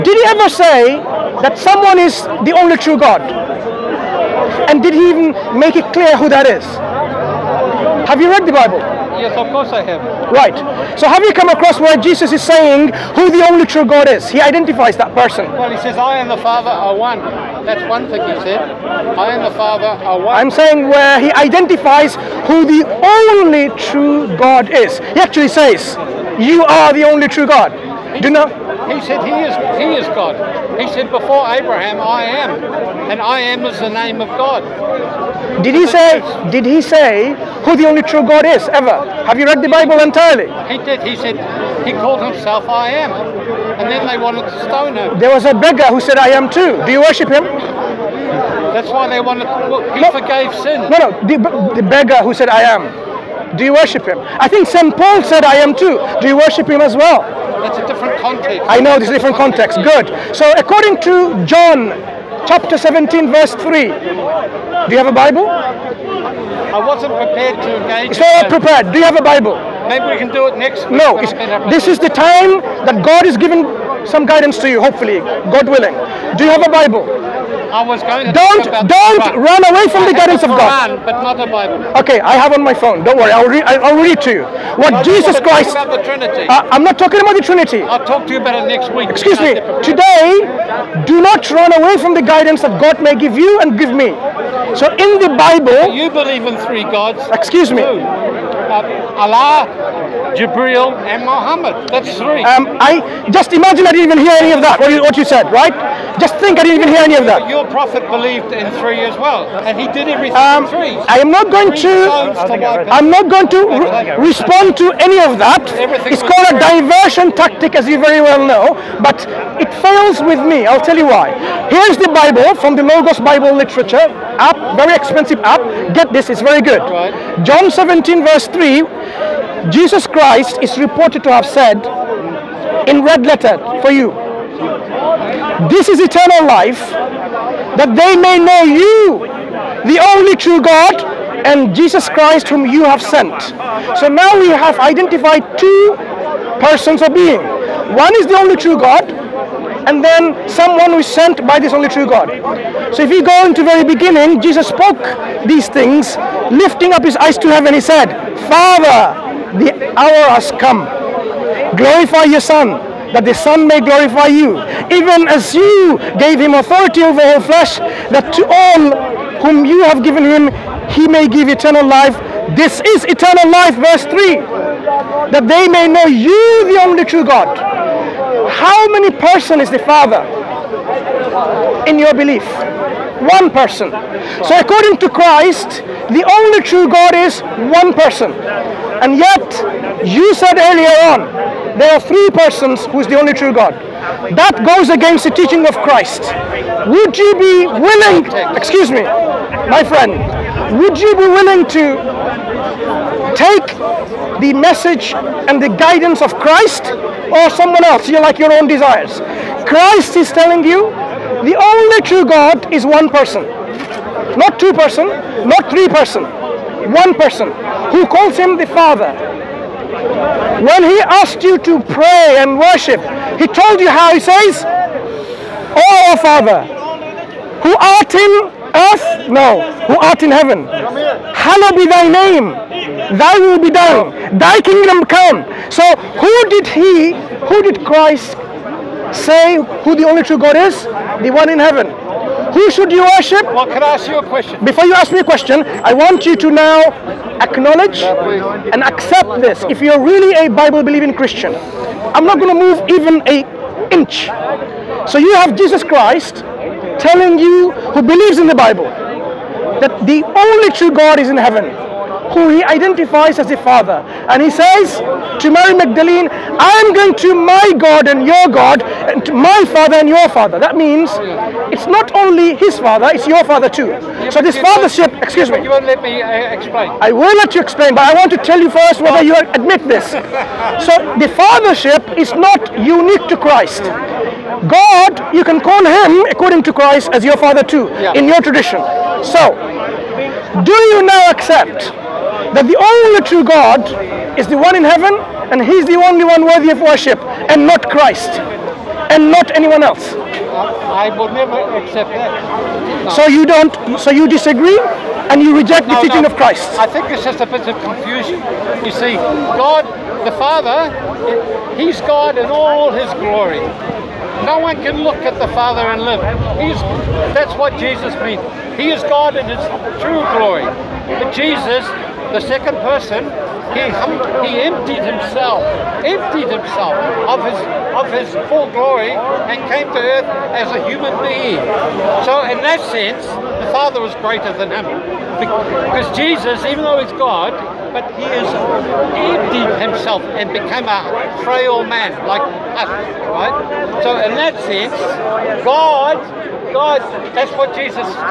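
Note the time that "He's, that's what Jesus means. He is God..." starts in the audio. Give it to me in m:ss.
5:16.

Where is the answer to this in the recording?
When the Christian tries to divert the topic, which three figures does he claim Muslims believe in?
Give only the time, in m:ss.
1:39.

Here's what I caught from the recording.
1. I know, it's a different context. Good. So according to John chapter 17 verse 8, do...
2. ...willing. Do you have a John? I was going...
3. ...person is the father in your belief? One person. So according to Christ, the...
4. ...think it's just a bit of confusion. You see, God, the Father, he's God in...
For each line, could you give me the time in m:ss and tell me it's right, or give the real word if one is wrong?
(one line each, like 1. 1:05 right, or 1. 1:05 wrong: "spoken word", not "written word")
1. 0:58 wrong: "3", not "8"
2. 1:15 wrong: "Bible", not "John"
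3. 2:59 right
4. 5:06 right.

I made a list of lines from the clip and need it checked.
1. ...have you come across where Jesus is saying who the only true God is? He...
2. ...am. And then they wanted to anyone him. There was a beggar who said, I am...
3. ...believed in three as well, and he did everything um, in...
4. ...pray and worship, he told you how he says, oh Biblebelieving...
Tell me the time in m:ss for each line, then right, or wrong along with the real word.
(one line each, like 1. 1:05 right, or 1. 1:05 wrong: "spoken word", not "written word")
1. 0:11 right
2. 0:42 wrong: "stone", not "anyone"
3. 1:48 right
4. 3:41 wrong: "Father", not "Biblebelieving".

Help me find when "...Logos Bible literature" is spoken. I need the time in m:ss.
2:02.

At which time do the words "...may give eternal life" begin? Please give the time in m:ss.
2:51.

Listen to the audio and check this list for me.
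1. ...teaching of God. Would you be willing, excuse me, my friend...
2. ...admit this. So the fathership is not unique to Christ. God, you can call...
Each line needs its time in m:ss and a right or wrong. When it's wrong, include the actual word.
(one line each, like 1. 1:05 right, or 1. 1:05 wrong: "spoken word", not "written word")
1. 3:15 wrong: "Christ", not "God"
2. 4:39 right.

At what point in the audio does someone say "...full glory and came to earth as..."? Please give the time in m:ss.
5:28.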